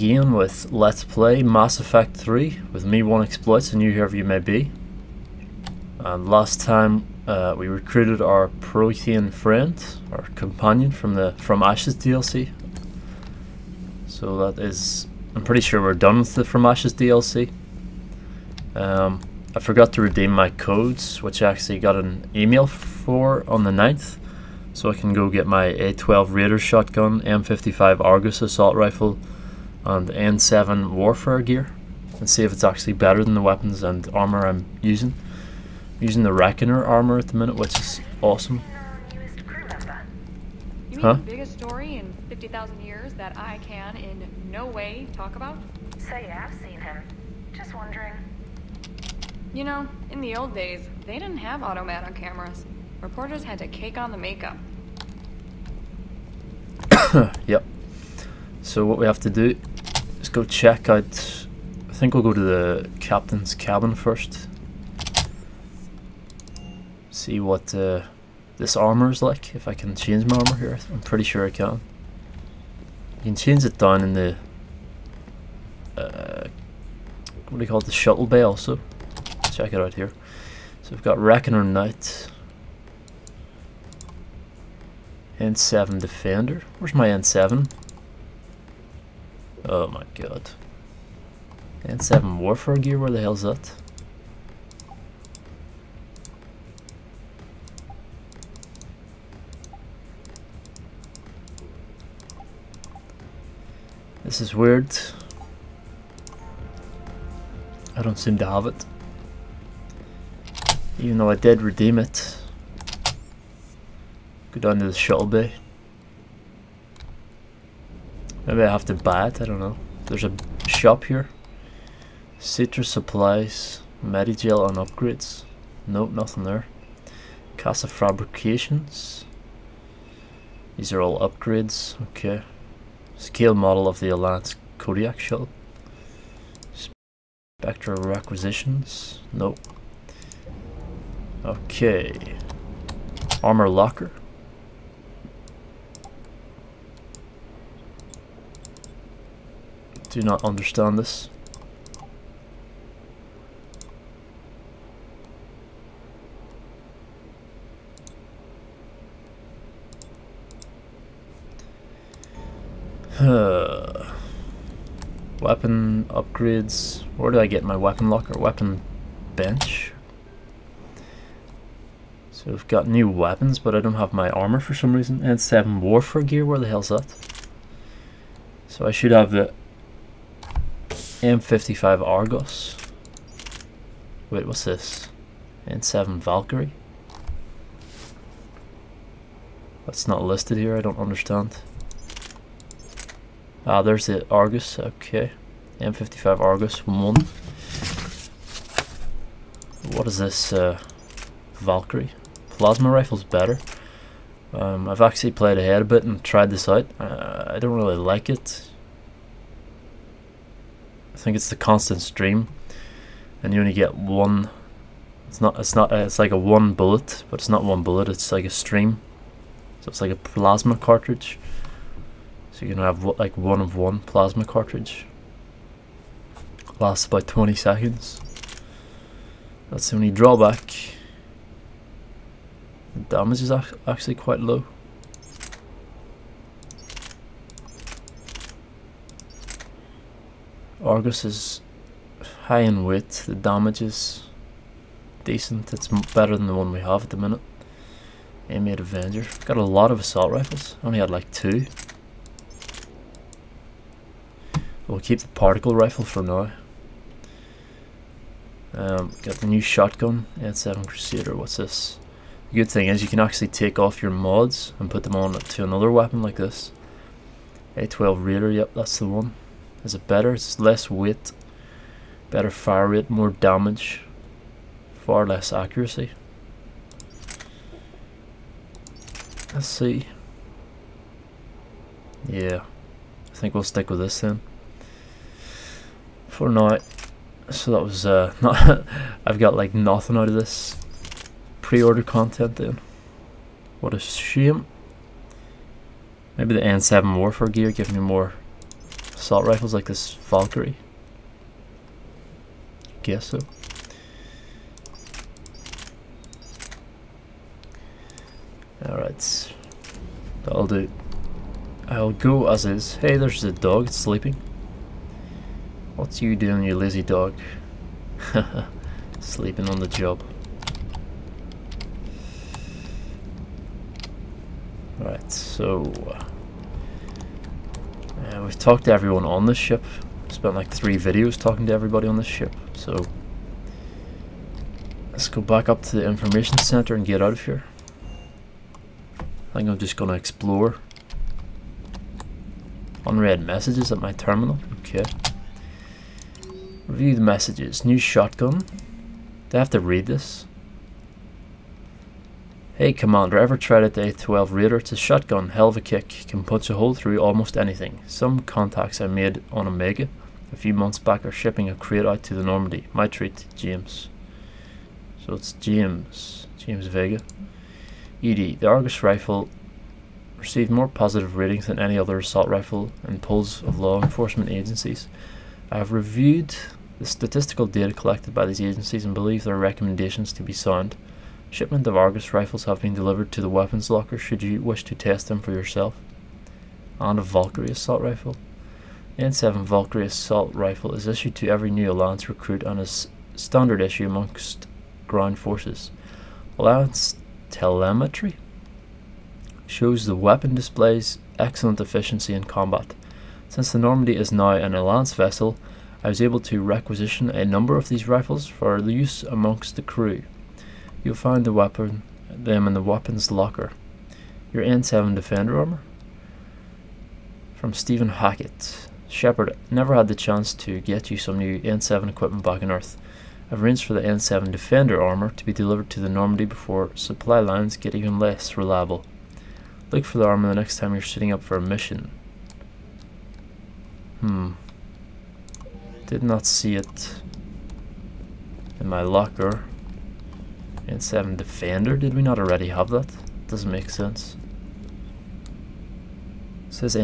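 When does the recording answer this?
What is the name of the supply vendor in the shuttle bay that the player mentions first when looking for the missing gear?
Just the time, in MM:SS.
02:02.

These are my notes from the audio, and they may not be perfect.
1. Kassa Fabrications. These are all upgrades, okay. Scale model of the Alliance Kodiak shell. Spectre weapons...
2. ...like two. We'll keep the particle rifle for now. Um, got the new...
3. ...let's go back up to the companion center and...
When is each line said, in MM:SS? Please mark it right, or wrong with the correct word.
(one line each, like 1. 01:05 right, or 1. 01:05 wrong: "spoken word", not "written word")
1. 02:07 wrong: "requisitions", not "weapons"
2. 04:11 right
3. 05:35 wrong: "information", not "companion".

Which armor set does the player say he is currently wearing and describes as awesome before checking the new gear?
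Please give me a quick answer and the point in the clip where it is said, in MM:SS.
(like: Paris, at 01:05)
Reckoner armor, at 00:36.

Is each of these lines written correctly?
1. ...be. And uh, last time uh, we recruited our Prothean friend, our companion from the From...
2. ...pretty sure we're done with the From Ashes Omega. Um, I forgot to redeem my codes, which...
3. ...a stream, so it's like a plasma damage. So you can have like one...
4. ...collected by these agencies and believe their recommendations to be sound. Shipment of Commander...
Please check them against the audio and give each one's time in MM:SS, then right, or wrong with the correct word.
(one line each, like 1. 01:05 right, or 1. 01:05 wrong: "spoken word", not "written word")
1. 00:04 right
2. 00:15 wrong: "DLC", not "Omega"
3. 03:38 wrong: "cartridge", not "damage"
4. 06:17 wrong: "Argus", not "Commander".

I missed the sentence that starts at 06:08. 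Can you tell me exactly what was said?
EDI, the Argus rifle received more positive ratings than any other assault rifle in polls of law enforcement agencies.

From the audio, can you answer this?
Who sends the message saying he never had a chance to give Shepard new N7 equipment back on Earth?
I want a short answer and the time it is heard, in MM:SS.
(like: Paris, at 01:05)
Steven Hackett, at 06:57.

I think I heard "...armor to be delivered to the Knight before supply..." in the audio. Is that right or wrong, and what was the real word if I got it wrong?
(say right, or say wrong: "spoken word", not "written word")
wrong: "Normandy", not "Knight".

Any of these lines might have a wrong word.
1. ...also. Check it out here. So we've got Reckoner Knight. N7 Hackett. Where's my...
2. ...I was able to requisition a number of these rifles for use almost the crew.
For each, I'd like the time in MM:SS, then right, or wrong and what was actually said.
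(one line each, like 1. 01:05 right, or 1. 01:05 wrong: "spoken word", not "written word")
1. 01:18 wrong: "Defender", not "Hackett"
2. 06:46 wrong: "amongst", not "almost".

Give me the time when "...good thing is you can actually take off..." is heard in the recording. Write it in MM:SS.
04:22.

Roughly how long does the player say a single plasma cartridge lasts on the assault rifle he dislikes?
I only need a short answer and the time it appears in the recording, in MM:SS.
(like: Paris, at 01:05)
20 seconds, at 03:47.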